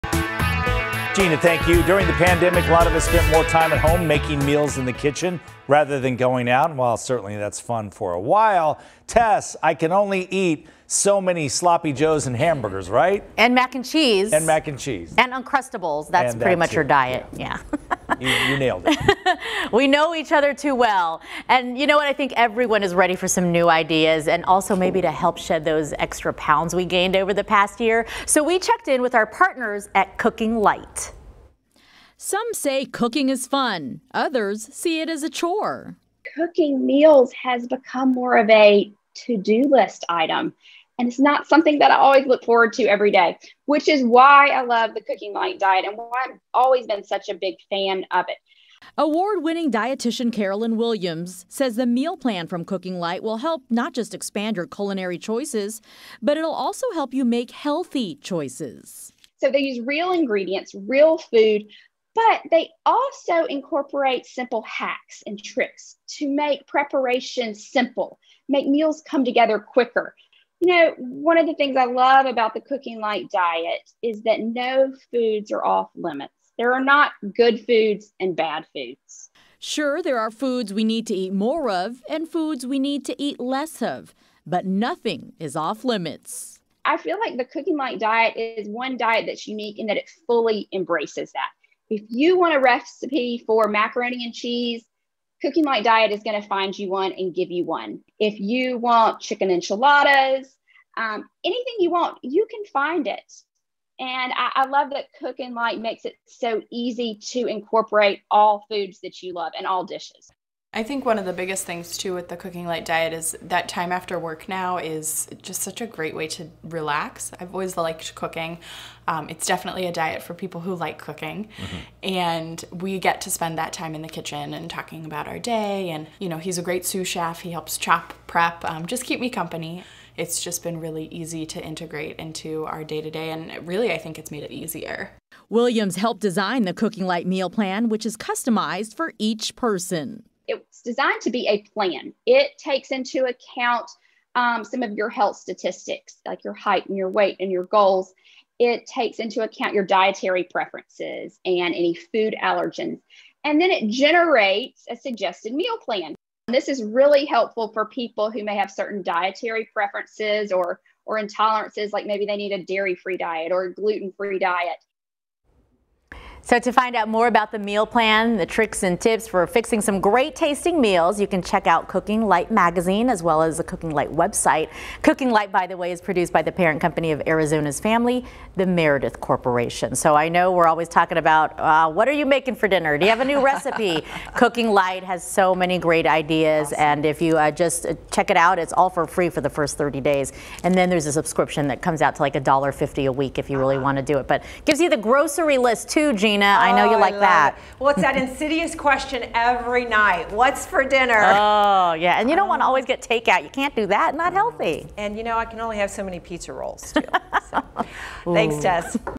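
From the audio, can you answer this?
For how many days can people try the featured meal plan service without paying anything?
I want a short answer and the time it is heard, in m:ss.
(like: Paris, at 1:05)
30, at 3:09.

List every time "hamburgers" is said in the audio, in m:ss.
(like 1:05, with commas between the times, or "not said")
0:12.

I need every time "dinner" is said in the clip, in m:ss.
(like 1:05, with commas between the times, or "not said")
3:02, 3:20.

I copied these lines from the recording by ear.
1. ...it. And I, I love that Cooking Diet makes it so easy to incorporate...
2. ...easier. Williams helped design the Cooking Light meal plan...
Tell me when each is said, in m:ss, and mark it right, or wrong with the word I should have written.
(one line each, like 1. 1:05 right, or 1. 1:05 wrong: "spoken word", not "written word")
1. 1:43 wrong: "Light", not "Diet"
2. 2:14 right.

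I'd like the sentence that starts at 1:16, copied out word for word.
There are not good foods and bad foods.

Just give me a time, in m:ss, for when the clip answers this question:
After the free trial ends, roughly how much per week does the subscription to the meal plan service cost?
3:12.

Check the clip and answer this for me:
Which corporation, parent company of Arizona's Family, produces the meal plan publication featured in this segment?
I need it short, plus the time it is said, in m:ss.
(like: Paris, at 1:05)
Meredith Corporation, at 2:58.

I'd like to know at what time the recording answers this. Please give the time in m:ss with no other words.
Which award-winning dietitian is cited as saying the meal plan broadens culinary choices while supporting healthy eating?
0:50.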